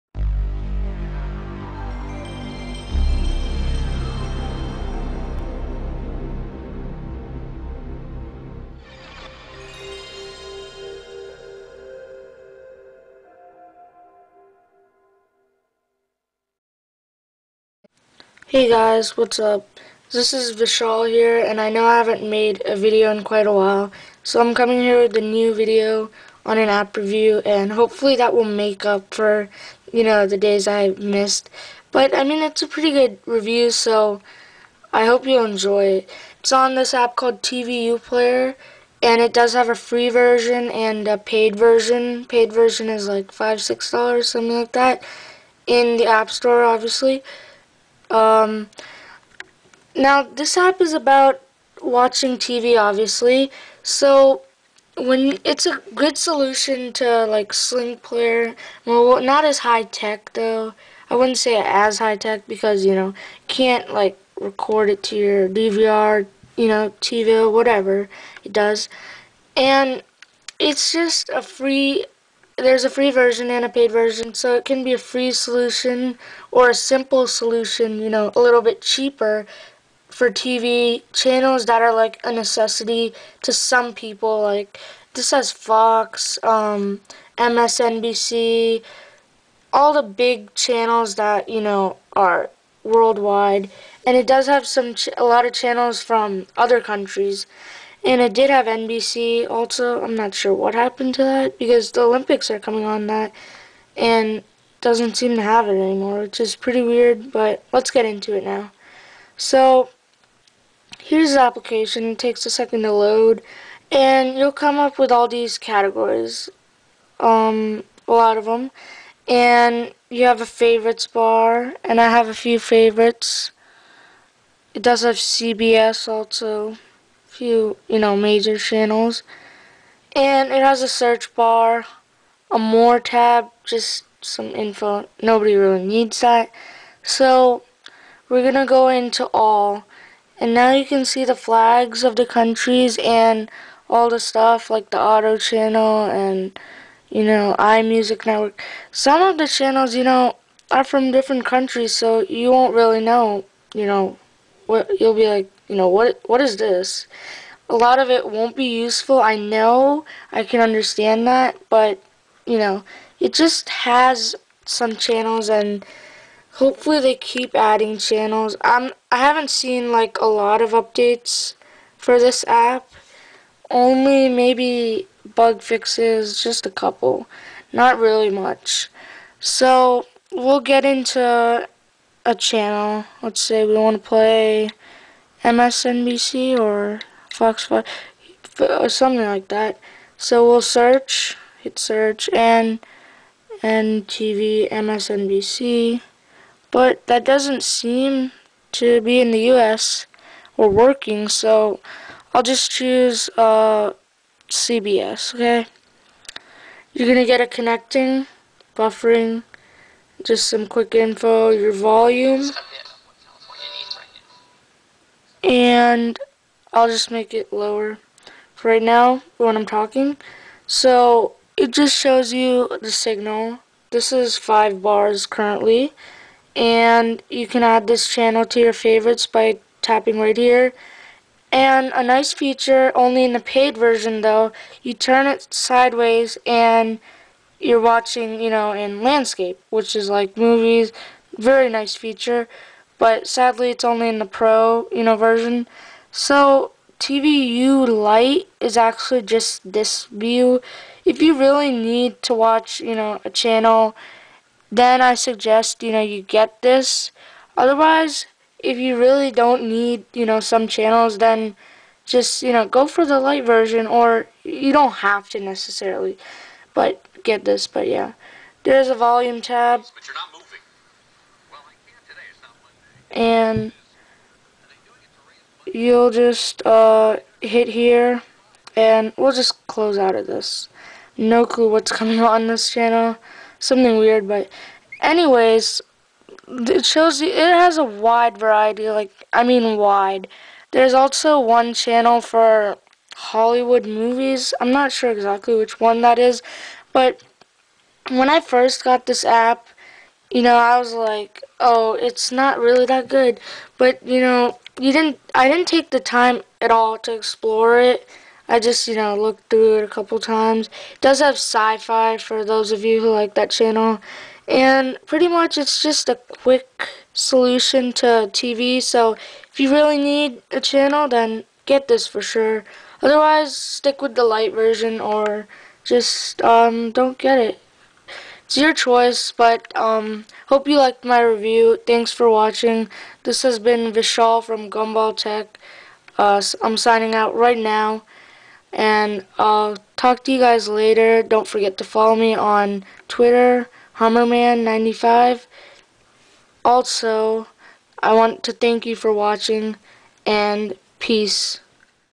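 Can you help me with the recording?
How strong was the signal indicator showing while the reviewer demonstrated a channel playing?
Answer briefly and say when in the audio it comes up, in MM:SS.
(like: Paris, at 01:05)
5 bars, at 03:44.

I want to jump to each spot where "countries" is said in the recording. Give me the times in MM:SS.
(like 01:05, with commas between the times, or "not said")
01:36, 02:22, 02:31.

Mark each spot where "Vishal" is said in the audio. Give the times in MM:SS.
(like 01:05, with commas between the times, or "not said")
00:20, 05:33.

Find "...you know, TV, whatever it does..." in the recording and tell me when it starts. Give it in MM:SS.
01:06.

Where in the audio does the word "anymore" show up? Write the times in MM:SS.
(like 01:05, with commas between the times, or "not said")
01:45.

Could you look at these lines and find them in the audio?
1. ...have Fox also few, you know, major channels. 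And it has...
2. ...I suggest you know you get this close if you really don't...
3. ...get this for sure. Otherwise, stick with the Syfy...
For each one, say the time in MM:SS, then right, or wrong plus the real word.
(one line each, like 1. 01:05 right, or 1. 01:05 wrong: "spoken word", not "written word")
1. 02:05 wrong: "CBS", not "Fox"
2. 04:15 wrong: "otherwise", not "close"
3. 05:21 wrong: "Lite", not "Syfy".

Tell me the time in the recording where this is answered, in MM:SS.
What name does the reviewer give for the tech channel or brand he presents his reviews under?
05:34.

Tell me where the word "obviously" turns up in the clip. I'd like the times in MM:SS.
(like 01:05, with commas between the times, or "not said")
00:46, 00:52.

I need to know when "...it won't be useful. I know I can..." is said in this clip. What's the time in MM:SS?
02:38.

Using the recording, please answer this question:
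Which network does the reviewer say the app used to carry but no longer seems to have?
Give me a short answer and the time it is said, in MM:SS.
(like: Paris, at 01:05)
NBC, at 01:38.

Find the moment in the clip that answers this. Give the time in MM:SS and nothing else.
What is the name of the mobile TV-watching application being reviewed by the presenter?
00:37.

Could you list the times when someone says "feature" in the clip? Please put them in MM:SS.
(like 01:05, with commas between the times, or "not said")
03:52, 04:01.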